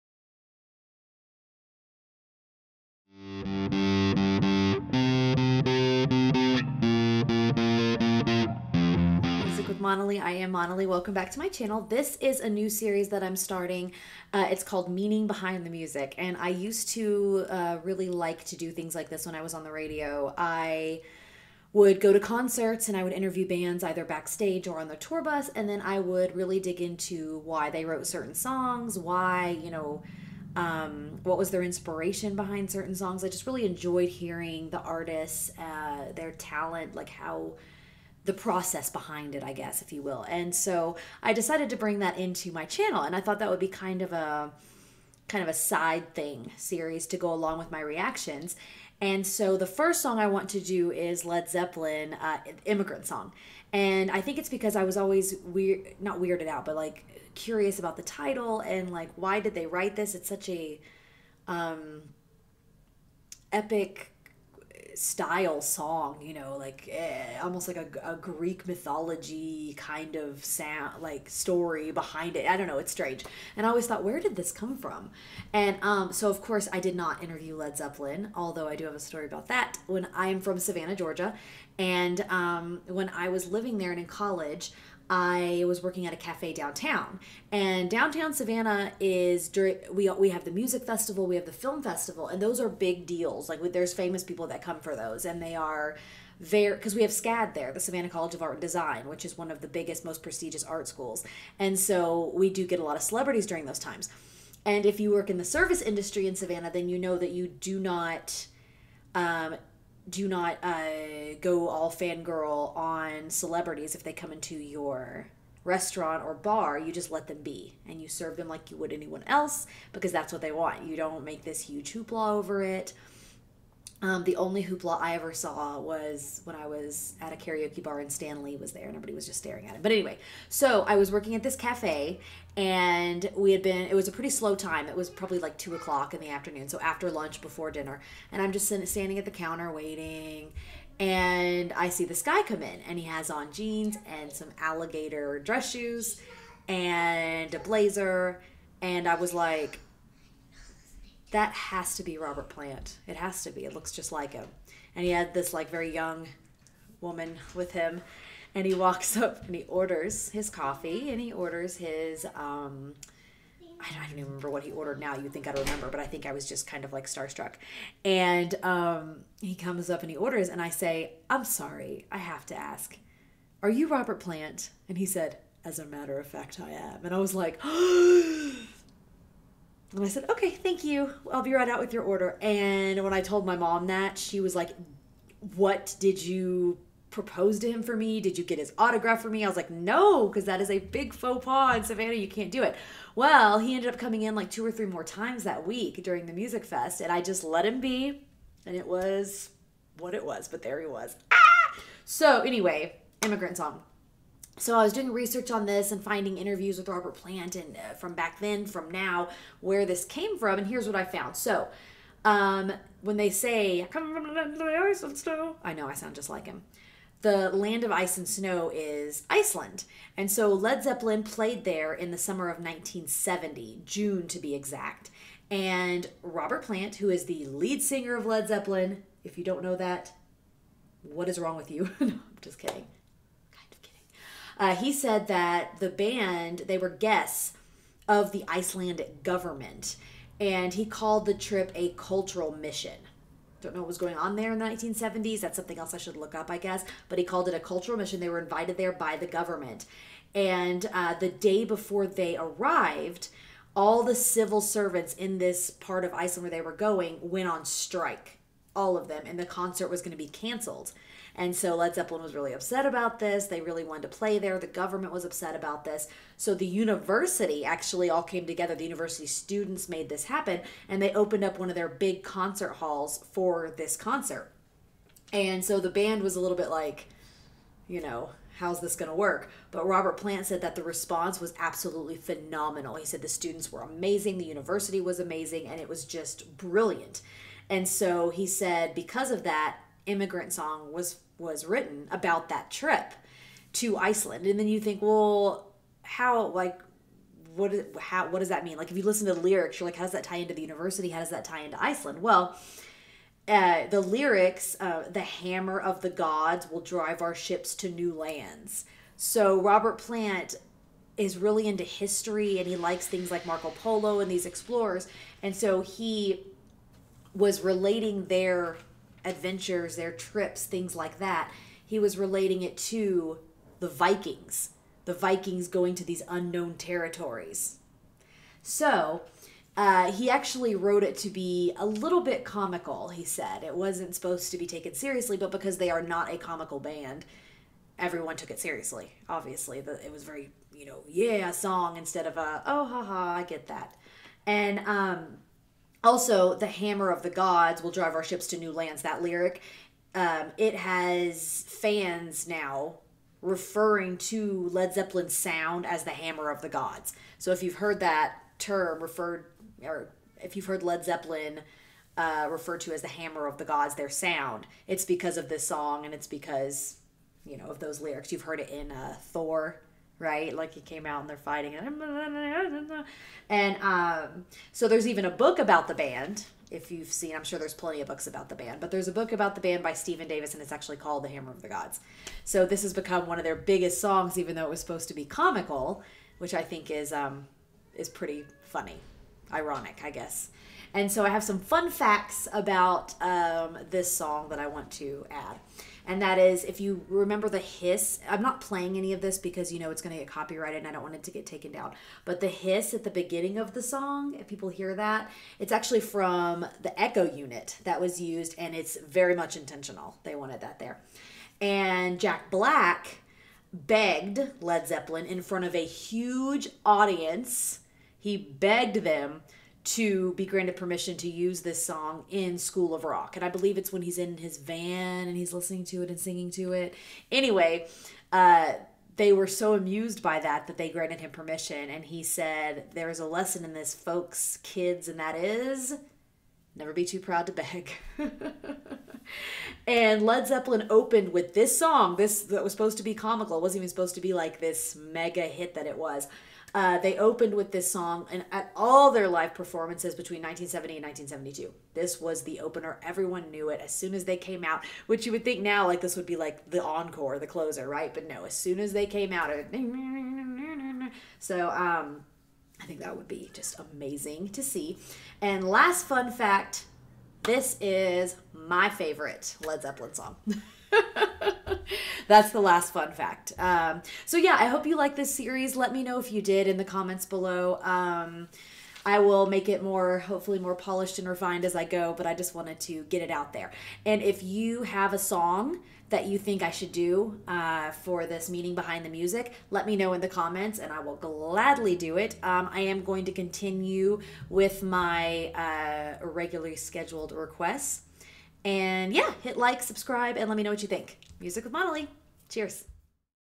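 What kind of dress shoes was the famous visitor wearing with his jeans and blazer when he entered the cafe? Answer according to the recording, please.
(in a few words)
Alligator.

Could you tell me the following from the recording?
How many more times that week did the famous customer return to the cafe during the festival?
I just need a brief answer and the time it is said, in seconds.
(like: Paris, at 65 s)
2 or 3, at 194 s.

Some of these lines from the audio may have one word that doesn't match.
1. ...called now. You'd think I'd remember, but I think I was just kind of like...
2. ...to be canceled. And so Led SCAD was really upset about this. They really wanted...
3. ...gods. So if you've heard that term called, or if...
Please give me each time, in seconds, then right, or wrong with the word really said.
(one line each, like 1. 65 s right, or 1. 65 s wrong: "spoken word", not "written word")
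1. 164 s wrong: "ordered", not "called"
2. 260 s wrong: "Zeppelin", not "SCAD"
3. 356 s wrong: "referred", not "called".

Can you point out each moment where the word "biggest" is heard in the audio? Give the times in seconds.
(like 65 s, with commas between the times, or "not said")
99 s, 383 s.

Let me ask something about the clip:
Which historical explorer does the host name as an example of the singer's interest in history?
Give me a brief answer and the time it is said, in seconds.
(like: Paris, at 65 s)
Marco Polo, at 313 s.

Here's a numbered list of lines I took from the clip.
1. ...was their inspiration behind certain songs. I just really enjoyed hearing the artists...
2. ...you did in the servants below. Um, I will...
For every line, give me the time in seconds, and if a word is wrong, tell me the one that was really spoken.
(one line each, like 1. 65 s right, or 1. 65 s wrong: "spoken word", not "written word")
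1. 31 s right
2. 476 s wrong: "comments", not "servants".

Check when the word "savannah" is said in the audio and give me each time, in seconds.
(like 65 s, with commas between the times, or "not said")
80 s, 88 s, 97 s, 106 s, 191 s.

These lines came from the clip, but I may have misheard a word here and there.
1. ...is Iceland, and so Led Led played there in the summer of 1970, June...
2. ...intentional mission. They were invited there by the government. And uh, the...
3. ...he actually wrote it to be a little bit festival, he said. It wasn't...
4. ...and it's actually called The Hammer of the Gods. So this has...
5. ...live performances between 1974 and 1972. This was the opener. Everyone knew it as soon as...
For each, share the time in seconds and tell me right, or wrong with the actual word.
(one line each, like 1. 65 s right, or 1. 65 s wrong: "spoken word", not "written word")
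1. 218 s wrong: "Zeppelin", not "Led"
2. 247 s wrong: "cultural", not "intentional"
3. 330 s wrong: "comical", not "festival"
4. 380 s right
5. 449 s wrong: "1970", not "1974".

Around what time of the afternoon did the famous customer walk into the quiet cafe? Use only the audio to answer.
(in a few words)
2 o'clock.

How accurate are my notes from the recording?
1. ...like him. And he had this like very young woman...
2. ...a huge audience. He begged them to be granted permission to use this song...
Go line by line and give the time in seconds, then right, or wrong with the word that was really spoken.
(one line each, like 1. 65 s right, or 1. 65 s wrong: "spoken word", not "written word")
1. 154 s right
2. 415 s right.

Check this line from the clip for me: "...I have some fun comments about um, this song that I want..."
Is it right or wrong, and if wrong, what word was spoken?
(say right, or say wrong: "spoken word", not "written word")
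wrong: "facts", not "comments".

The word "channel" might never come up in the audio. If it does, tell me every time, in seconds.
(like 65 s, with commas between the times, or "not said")
11 s, 42 s.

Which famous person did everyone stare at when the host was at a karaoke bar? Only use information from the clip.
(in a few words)
Stan Lee.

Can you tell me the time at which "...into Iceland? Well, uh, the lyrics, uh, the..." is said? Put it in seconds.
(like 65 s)
301 s.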